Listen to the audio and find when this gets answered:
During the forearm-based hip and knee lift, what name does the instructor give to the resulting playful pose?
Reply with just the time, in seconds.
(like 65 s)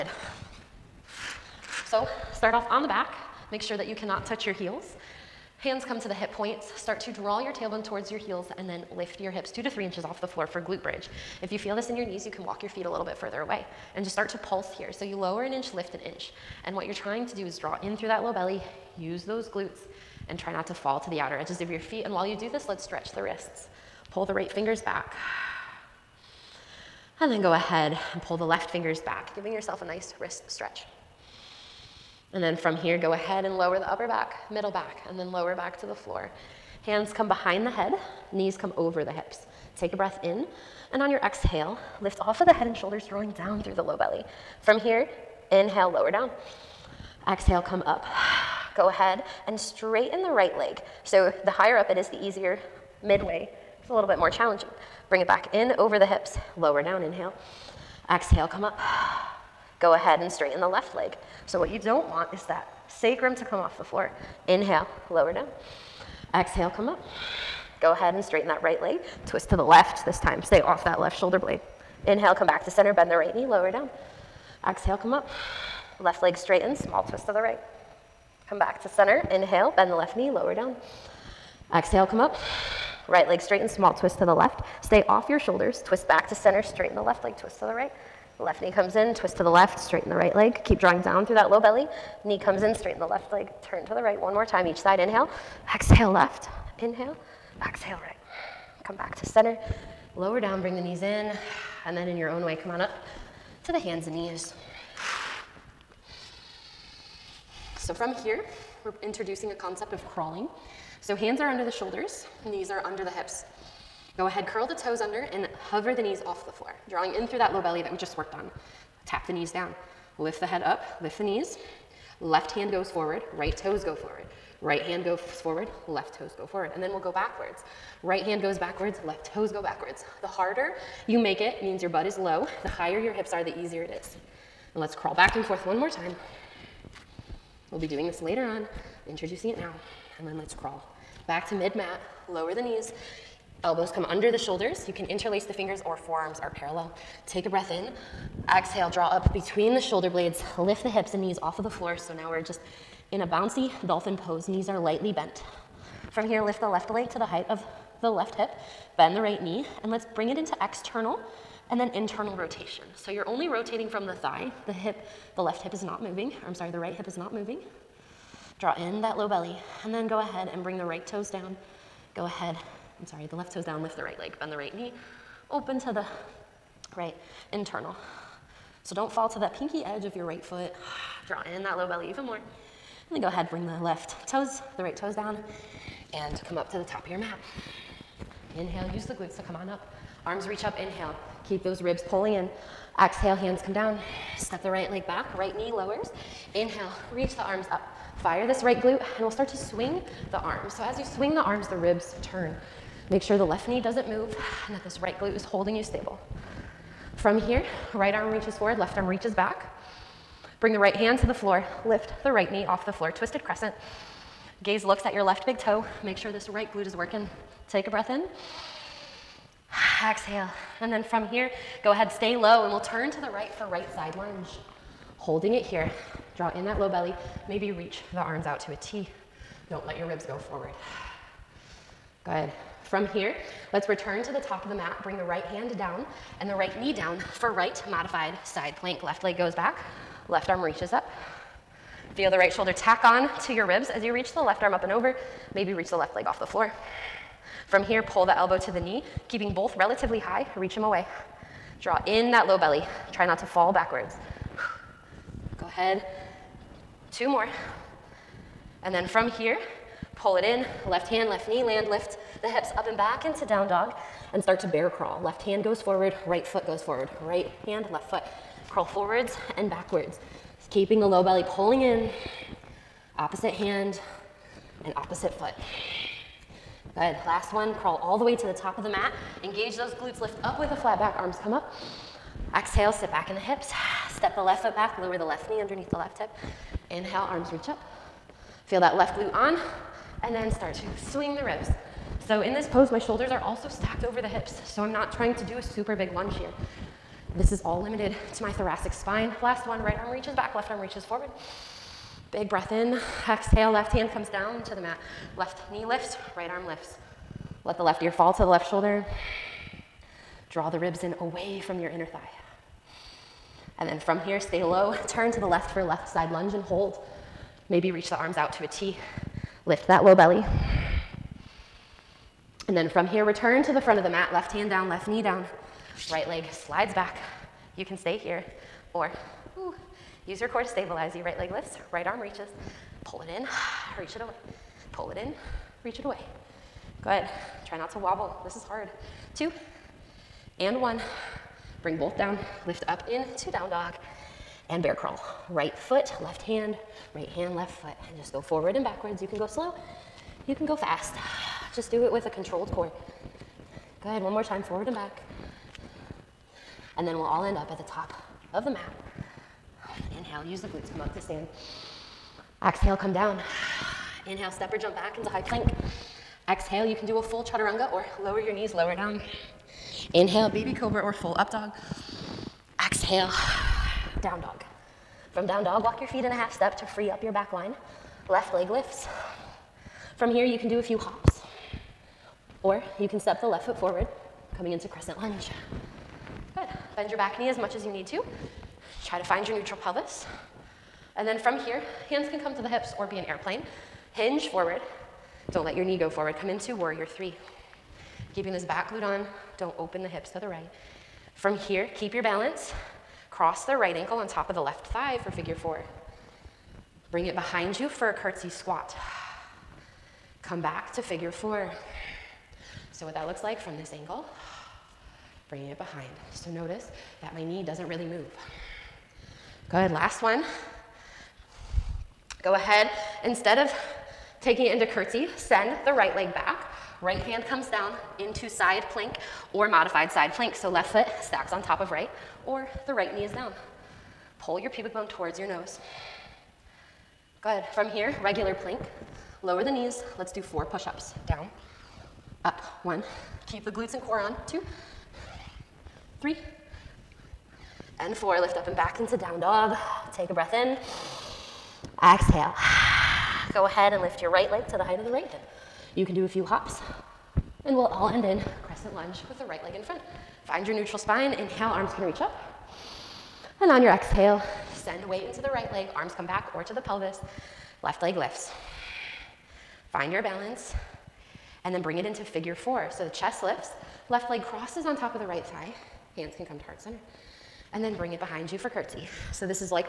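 153 s.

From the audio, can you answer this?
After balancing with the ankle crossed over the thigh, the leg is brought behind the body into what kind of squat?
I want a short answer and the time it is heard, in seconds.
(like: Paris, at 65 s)
Curtsy squat, at 408 s.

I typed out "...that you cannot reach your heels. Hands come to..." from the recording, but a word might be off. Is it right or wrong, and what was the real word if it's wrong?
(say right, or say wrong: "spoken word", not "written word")
wrong: "touch", not "reach".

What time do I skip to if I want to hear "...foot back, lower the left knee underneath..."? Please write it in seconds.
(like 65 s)
284 s.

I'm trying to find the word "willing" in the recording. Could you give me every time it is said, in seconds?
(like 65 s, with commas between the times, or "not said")
not said.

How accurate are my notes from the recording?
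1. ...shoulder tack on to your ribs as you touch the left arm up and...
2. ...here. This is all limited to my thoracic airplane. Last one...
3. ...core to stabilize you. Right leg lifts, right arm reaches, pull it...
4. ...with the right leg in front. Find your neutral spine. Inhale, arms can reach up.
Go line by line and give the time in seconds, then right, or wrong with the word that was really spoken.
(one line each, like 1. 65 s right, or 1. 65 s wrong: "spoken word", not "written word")
1. 242 s wrong: "reach", not "touch"
2. 296 s wrong: "spine", not "airplane"
3. 330 s right
4. 459 s right.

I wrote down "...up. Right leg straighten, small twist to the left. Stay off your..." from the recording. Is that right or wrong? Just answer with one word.
right.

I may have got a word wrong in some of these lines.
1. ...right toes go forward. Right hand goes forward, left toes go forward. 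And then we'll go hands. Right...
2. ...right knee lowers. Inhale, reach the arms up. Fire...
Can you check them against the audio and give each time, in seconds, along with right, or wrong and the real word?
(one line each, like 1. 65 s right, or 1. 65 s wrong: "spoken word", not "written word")
1. 123 s wrong: "backwards", not "hands"
2. 195 s right.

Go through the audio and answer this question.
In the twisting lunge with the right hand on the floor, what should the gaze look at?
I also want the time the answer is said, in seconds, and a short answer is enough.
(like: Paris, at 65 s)
Left big toe, at 215 s.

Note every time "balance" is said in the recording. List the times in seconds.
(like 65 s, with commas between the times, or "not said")
402 s, 470 s.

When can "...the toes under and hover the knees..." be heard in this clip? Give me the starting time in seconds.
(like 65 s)
114 s.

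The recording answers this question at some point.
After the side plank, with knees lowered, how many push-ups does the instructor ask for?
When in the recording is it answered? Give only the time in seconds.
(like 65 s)
440 s.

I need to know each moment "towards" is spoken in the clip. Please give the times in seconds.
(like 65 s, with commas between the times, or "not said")
7 s, 435 s.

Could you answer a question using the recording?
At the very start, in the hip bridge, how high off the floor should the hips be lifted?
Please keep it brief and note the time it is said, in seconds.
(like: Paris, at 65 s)
2 to 3 inches, at 9 s.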